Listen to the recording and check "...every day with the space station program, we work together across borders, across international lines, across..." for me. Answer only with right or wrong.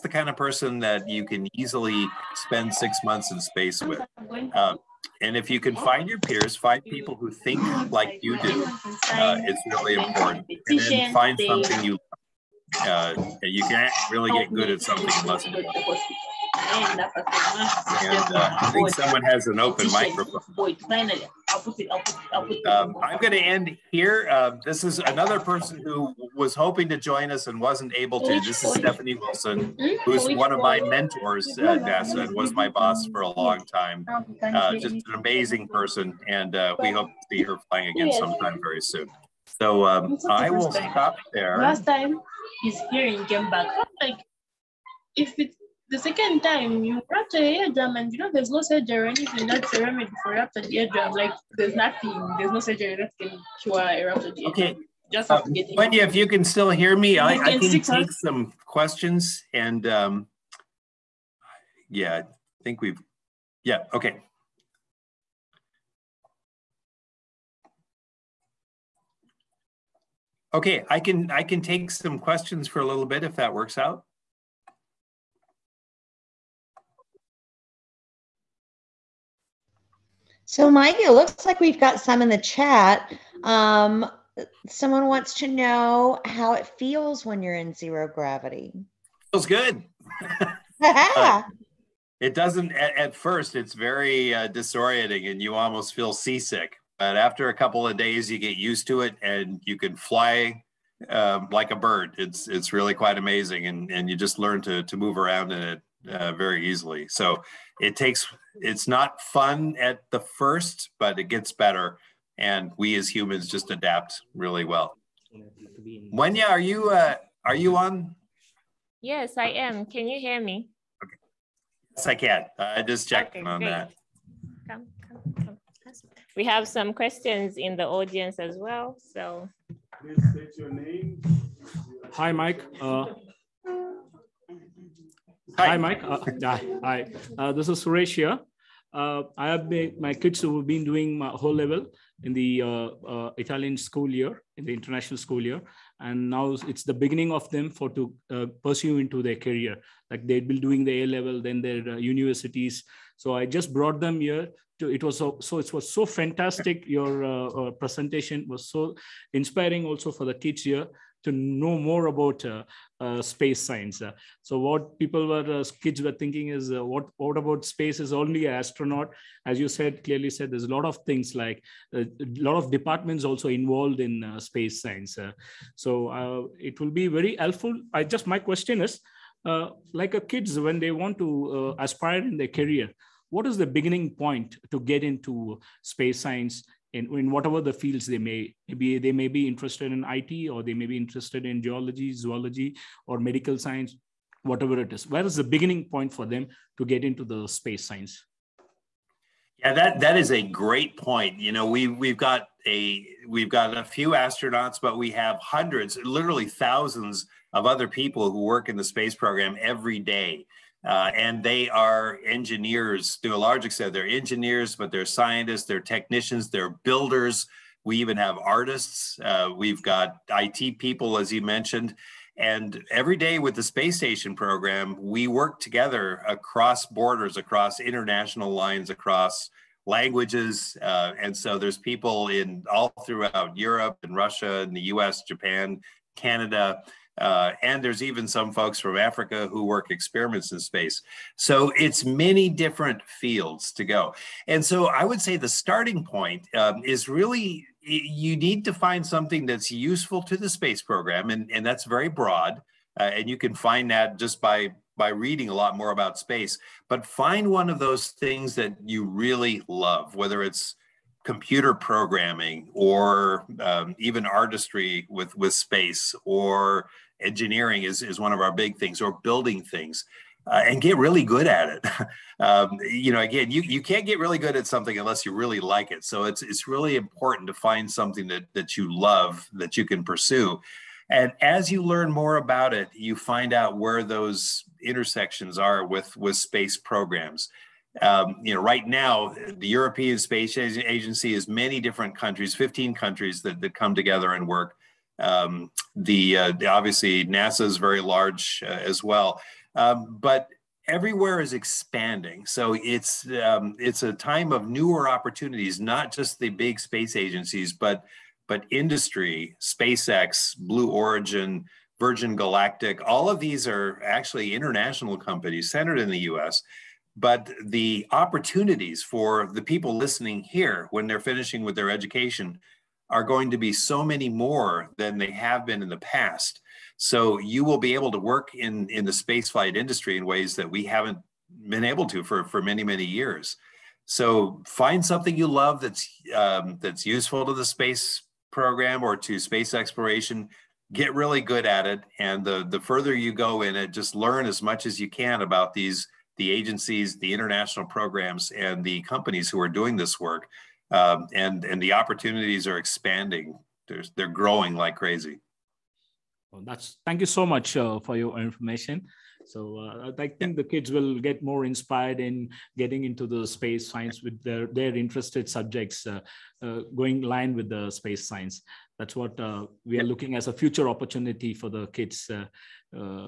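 right.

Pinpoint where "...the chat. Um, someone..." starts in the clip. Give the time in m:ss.
1:22.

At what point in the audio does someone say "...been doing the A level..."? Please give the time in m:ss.
2:30.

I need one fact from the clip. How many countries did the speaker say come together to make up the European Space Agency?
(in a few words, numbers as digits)
15.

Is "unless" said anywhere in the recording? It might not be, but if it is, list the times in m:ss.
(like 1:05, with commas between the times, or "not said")
0:15, 4:34.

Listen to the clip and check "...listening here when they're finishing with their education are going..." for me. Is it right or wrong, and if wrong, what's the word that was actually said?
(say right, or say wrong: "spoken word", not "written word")
right.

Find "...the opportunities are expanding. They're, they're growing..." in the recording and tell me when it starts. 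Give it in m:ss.
5:51.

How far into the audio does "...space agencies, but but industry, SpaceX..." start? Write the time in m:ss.
5:06.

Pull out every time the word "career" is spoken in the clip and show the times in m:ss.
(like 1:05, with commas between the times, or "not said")
2:29, 3:02.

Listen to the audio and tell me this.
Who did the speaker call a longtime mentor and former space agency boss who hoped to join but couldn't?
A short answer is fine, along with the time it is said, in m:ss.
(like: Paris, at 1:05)
Stephanie Wilson, at 0:28.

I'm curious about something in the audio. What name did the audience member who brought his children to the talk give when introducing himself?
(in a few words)
Suresh.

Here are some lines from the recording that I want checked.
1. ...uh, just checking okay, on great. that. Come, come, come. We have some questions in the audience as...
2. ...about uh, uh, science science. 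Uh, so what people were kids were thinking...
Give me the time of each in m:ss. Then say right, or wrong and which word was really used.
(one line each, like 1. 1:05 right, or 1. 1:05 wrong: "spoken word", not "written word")
1. 2:02 right
2. 2:42 wrong: "space", not "science".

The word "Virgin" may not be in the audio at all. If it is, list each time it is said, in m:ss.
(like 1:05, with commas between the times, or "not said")
5:11.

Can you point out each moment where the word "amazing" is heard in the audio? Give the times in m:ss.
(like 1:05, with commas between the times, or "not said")
0:35, 1:43.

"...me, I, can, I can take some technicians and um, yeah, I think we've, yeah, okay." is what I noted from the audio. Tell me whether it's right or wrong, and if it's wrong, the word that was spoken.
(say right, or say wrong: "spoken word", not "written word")
wrong: "questions", not "technicians".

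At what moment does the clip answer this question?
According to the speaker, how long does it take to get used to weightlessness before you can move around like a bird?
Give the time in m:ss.
1:37.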